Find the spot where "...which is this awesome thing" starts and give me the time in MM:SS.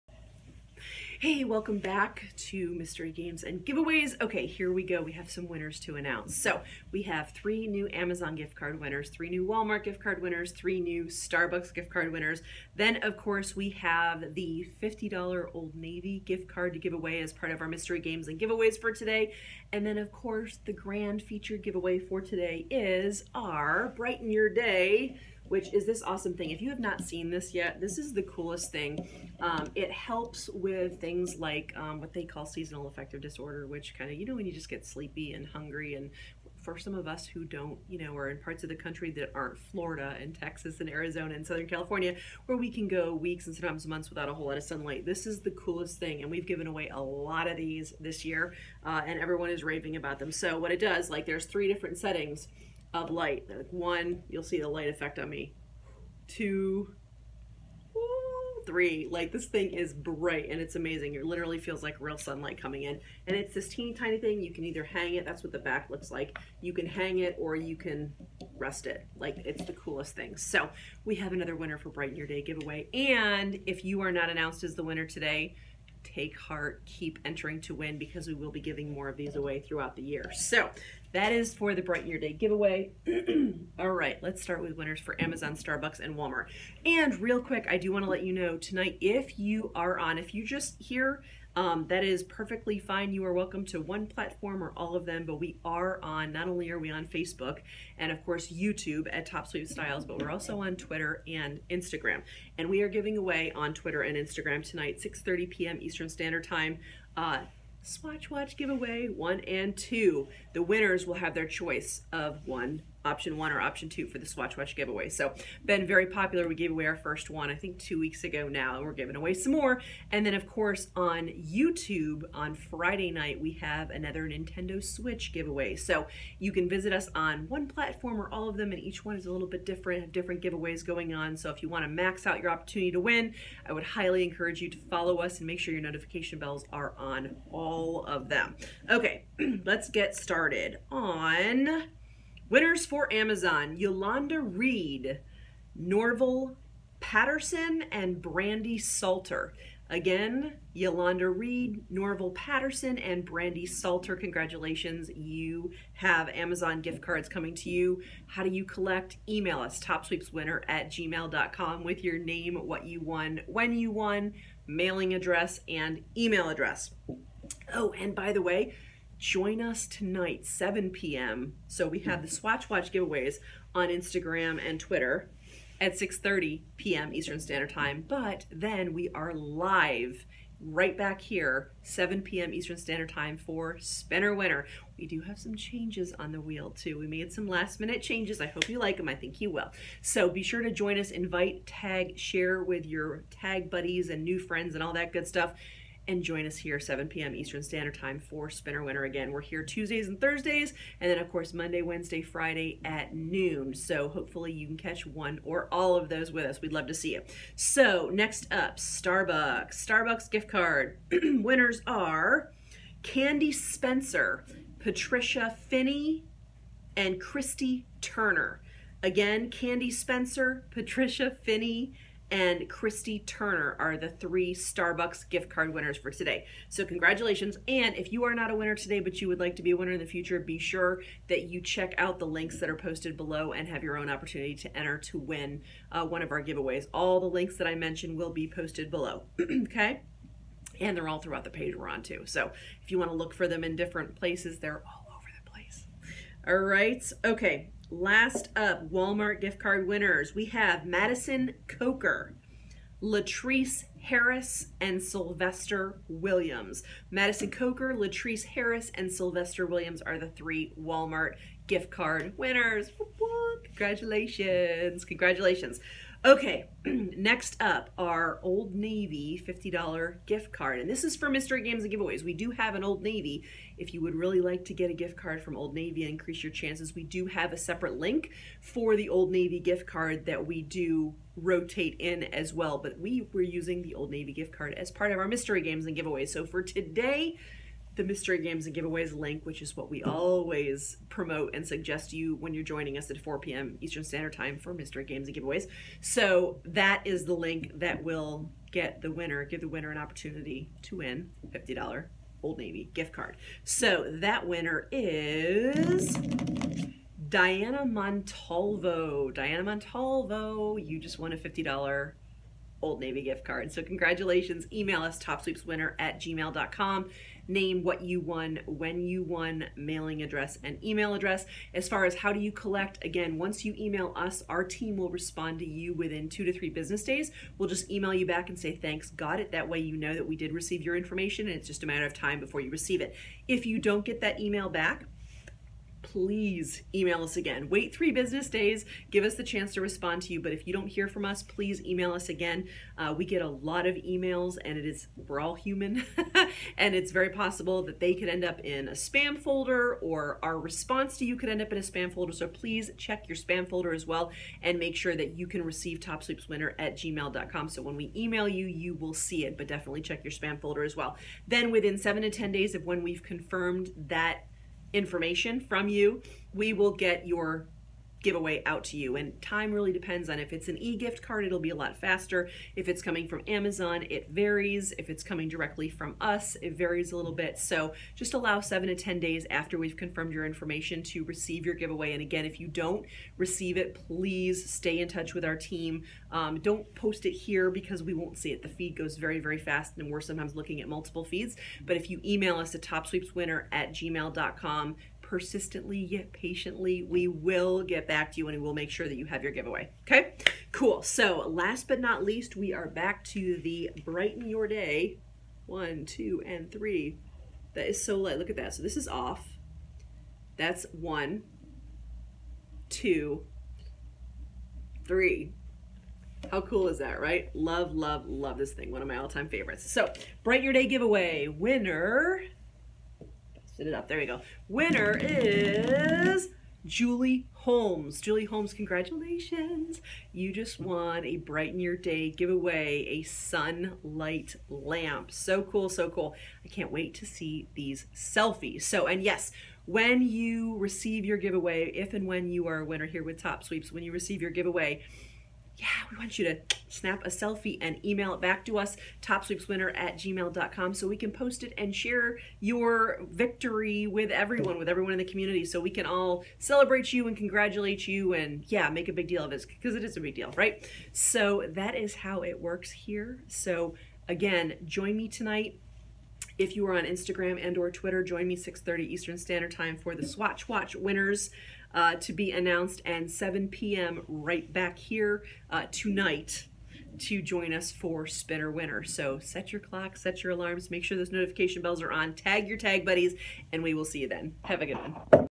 00:25.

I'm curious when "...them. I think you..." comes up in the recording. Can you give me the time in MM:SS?
03:08.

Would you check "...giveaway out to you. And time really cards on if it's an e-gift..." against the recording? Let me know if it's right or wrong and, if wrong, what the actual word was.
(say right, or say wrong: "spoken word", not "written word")
wrong: "depends", not "cards".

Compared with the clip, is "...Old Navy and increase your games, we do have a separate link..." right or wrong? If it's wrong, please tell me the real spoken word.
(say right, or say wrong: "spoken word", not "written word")
wrong: "chances", not "games".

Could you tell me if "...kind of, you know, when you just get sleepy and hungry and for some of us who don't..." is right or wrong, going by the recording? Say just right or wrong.
right.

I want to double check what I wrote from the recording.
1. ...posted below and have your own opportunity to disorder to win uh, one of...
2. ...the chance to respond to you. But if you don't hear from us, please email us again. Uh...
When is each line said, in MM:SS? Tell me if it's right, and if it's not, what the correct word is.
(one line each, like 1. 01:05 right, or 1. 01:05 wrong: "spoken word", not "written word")
1. 03:52 wrong: "enter", not "disorder"
2. 05:39 right.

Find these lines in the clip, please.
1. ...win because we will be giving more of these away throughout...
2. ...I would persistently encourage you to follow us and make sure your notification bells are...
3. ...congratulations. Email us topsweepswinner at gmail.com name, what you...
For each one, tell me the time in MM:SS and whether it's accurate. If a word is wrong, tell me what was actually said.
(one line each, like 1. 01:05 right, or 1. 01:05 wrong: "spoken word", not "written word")
1. 01:17 right
2. 02:13 wrong: "highly", not "persistently"
3. 05:13 right.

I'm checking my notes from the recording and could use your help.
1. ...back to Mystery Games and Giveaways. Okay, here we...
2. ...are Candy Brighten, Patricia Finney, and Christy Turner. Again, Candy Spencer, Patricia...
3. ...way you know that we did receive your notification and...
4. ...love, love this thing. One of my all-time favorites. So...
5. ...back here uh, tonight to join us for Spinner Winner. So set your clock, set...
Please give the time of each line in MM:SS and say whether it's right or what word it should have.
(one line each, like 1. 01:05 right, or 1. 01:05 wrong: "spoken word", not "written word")
1. 00:01 right
2. 03:31 wrong: "Spencer", not "Brighten"
3. 05:29 wrong: "information", not "notification"
4. 06:57 right
5. 07:54 right.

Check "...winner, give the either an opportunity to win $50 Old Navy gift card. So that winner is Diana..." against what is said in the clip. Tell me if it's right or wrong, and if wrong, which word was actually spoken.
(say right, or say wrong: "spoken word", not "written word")
wrong: "winner", not "either".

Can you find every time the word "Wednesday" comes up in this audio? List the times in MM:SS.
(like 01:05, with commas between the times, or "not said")
03:21.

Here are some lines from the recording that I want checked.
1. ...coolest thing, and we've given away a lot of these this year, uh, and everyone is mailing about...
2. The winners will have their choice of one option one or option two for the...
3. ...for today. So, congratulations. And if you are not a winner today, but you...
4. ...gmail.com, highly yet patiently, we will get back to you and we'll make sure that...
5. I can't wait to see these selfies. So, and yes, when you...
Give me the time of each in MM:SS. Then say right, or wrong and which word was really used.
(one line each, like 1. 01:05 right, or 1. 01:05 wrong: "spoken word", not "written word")
1. 00:45 wrong: "raving", not "mailing"
2. 01:50 right
3. 03:45 right
4. 06:33 wrong: "persistently", not "highly"
5. 07:16 right.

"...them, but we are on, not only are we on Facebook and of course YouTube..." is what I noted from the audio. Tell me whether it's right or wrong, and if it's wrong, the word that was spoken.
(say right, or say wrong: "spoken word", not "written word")
right.